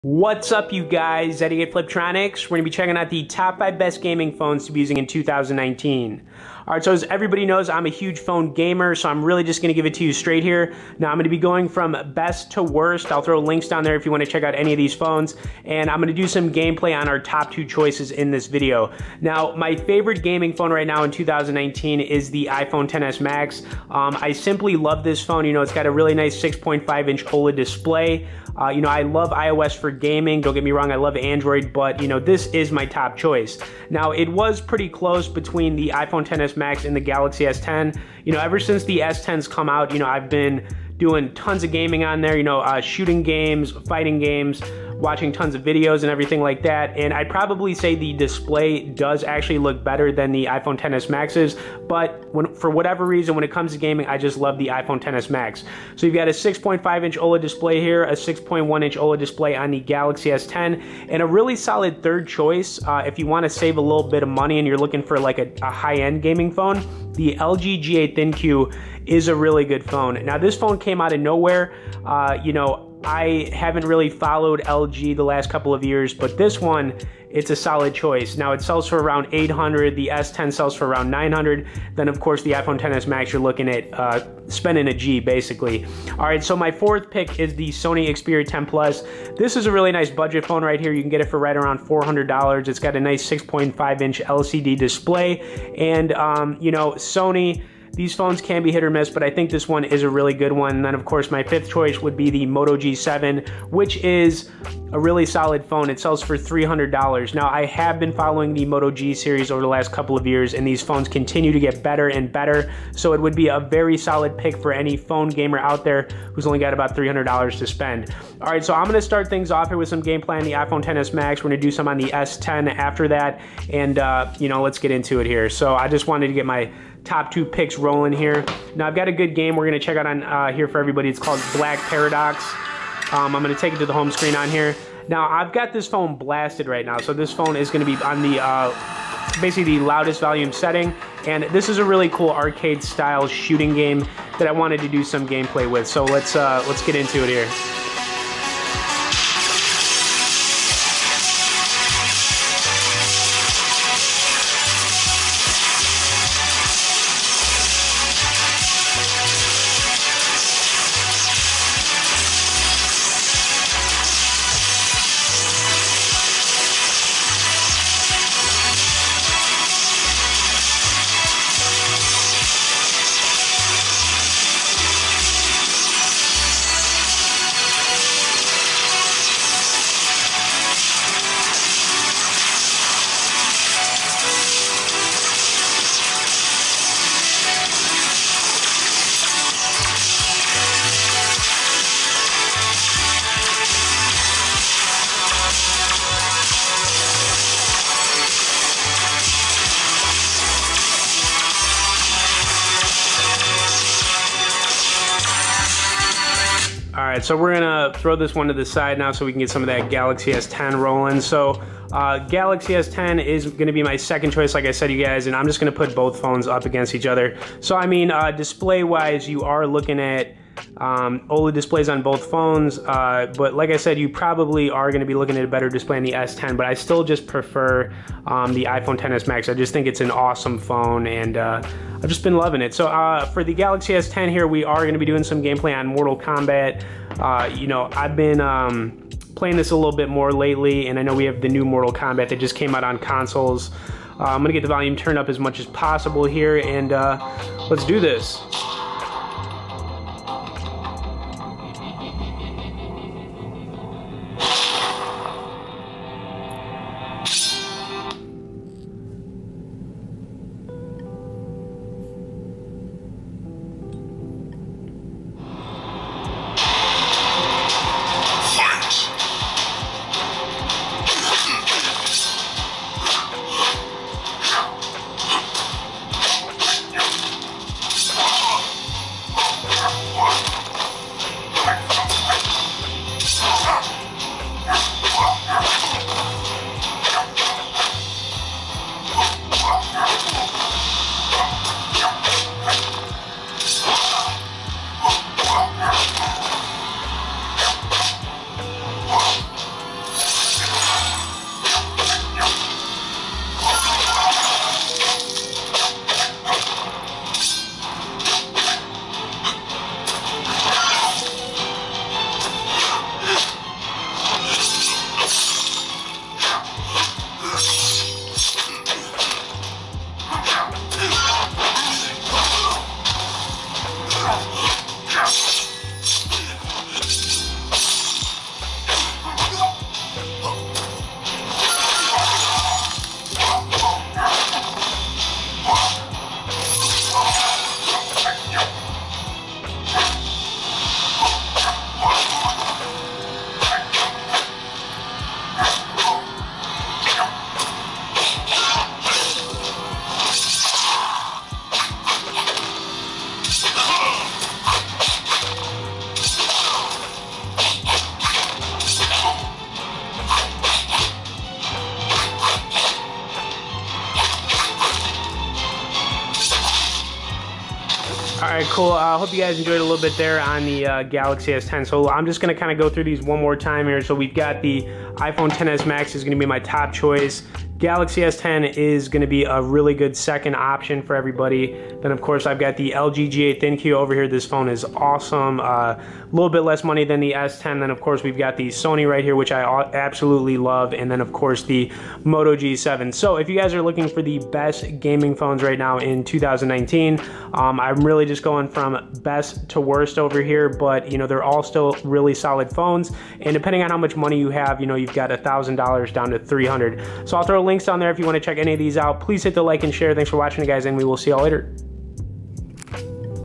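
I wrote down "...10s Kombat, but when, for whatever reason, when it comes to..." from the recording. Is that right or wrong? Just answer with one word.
wrong.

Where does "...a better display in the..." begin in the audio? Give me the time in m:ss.
3:45.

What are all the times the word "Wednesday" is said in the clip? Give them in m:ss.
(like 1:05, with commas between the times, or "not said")
not said.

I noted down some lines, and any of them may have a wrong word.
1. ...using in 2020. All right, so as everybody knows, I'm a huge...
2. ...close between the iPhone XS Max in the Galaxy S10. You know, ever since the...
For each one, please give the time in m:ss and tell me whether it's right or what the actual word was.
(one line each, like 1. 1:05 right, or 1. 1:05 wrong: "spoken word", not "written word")
1. 0:04 wrong: "2019", not "2020"
2. 0:34 right.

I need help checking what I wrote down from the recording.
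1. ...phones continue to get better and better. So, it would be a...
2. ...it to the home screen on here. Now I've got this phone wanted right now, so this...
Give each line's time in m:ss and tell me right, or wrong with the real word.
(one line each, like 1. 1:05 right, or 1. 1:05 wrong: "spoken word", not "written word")
1. 1:50 right
2. 2:13 wrong: "blasted", not "wanted".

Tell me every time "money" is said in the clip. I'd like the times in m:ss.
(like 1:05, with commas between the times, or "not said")
1:04, 6:26, 6:44.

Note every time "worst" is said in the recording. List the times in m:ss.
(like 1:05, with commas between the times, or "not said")
0:12, 6:39.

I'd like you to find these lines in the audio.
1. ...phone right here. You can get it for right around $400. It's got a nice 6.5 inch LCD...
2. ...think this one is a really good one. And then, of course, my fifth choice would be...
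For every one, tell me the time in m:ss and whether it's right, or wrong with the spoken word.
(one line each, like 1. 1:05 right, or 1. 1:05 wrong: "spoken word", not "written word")
1. 1:30 right
2. 1:39 right.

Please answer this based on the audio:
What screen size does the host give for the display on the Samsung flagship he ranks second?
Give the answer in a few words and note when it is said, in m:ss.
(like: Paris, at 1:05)
6.1 inch, at 0:58.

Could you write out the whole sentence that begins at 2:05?
So, I just wanted to get my top two picks rolling here.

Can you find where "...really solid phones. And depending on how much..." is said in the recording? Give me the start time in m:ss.
6:42.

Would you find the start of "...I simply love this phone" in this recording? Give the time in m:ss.
0:24.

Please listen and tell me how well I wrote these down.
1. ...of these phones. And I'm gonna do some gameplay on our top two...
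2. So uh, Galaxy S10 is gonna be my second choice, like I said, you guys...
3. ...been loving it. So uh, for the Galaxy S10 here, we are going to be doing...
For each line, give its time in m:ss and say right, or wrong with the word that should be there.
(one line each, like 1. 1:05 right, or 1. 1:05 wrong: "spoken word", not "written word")
1. 0:14 right
2. 3:31 right
3. 3:52 right.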